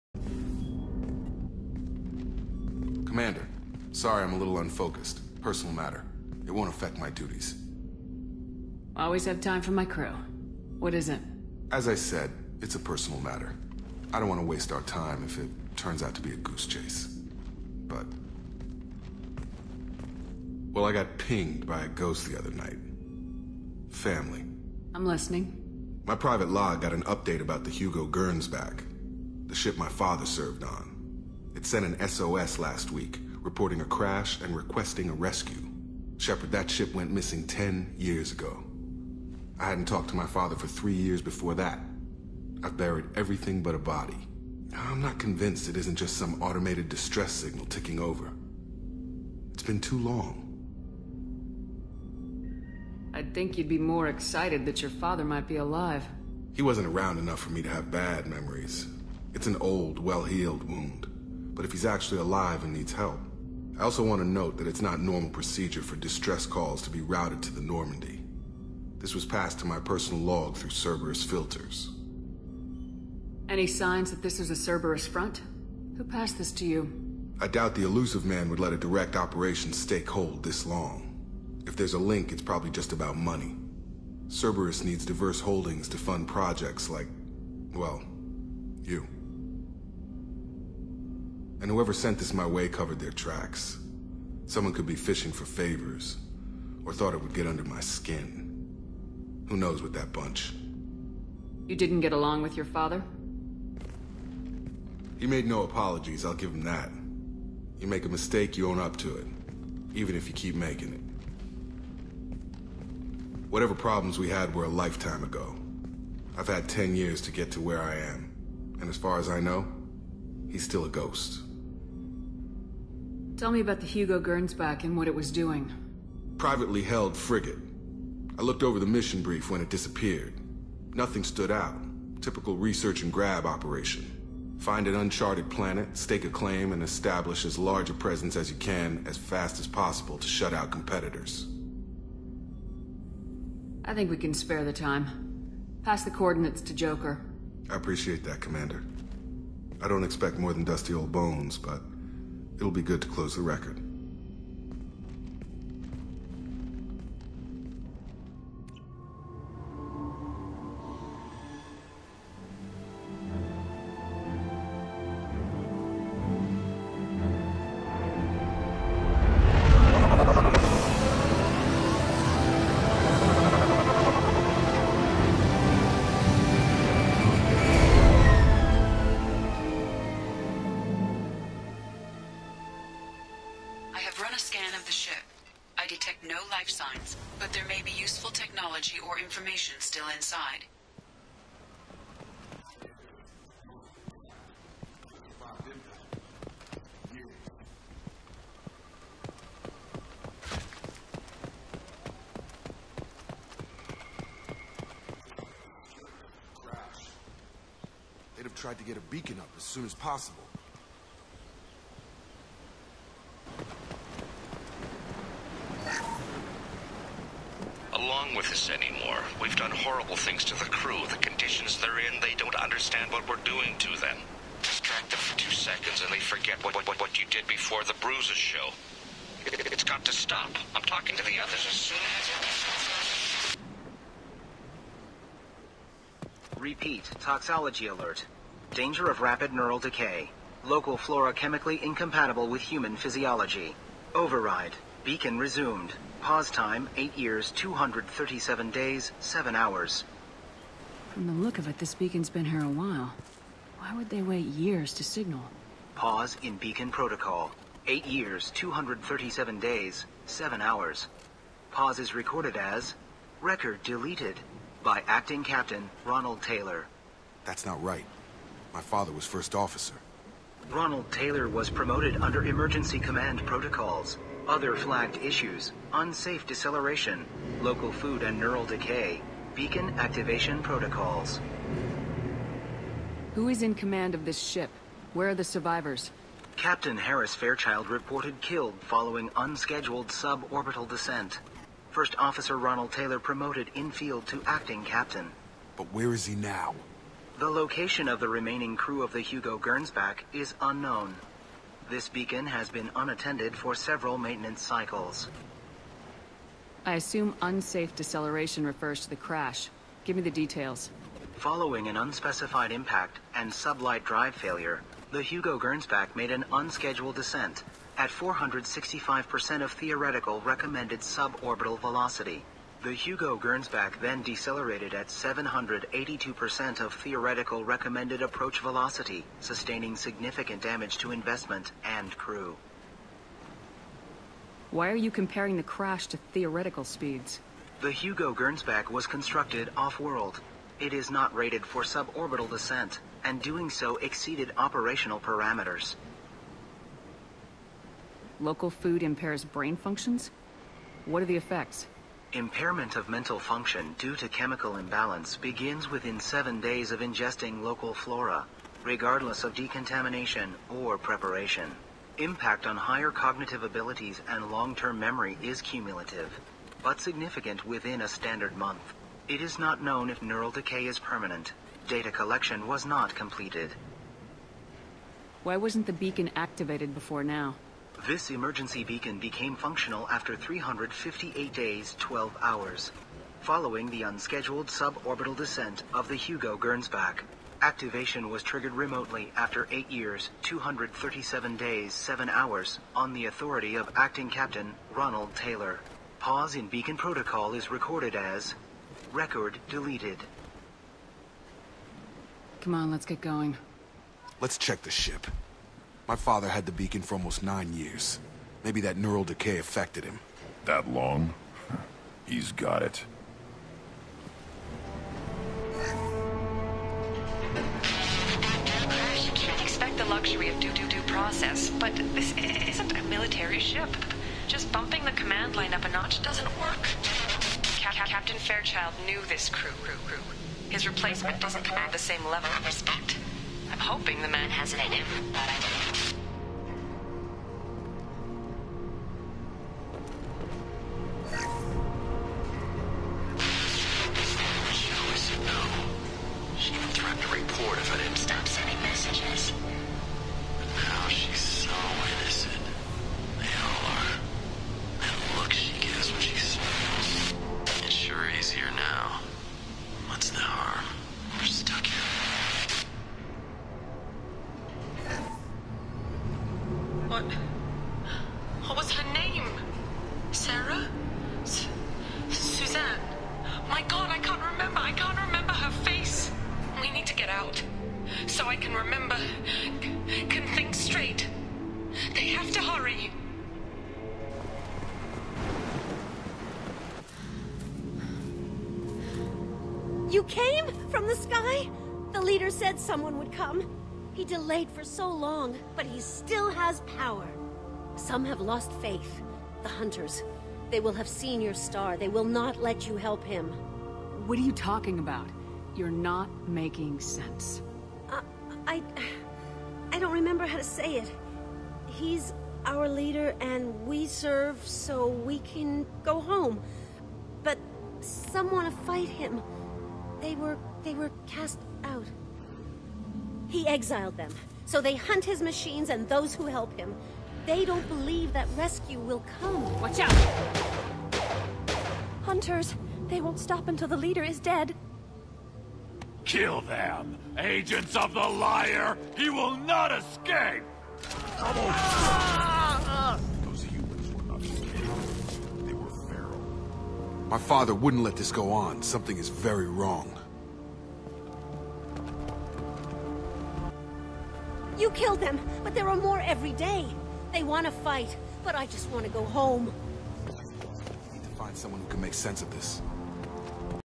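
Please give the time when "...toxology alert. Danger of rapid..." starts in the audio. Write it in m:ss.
3:57.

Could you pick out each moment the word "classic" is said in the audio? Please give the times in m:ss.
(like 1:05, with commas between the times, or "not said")
not said.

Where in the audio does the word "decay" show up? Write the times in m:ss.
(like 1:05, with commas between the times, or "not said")
3:59, 4:38, 6:10, 6:49.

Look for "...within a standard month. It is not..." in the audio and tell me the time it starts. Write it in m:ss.
6:07.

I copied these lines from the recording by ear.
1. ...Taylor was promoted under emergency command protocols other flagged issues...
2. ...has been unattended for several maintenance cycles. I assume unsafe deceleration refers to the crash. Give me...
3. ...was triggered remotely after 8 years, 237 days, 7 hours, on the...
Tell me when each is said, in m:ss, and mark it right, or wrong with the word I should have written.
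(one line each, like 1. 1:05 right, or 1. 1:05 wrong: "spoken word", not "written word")
1. 4:31 right
2. 5:02 right
3. 6:28 right.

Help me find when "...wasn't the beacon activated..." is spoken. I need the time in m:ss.
6:15.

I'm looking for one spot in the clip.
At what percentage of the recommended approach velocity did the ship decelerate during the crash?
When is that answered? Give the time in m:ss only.
5:25.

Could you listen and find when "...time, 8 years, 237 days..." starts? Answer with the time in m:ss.
4:06.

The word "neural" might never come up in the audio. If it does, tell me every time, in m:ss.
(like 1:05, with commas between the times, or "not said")
3:59, 4:38, 6:10, 6:48.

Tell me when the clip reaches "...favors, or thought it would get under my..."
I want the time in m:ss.
1:35.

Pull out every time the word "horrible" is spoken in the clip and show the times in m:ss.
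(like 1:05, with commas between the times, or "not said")
3:39.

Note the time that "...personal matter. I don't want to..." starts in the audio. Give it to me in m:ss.
0:12.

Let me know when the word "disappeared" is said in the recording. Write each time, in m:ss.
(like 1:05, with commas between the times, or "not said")
2:09.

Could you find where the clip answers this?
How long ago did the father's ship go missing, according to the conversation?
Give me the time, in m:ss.
0:37.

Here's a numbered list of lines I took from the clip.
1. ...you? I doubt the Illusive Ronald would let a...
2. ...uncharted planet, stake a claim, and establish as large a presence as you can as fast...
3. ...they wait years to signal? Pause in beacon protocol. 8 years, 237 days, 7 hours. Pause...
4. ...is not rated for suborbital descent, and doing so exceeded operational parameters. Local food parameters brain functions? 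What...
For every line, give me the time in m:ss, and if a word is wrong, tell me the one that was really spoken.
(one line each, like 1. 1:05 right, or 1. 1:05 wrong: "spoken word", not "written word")
1. 1:16 wrong: "Man", not "Ronald"
2. 2:14 right
3. 4:14 right
4. 5:40 wrong: "impairs", not "parameters".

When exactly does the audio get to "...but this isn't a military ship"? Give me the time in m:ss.
7:01.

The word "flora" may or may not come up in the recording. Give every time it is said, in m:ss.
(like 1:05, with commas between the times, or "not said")
4:00, 5:57.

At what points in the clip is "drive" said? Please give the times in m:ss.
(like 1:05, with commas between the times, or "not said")
5:14.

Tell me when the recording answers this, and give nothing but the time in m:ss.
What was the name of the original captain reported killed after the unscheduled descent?
4:46.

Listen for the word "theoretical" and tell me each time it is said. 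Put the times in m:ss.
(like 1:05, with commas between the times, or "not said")
5:19, 5:26, 5:36.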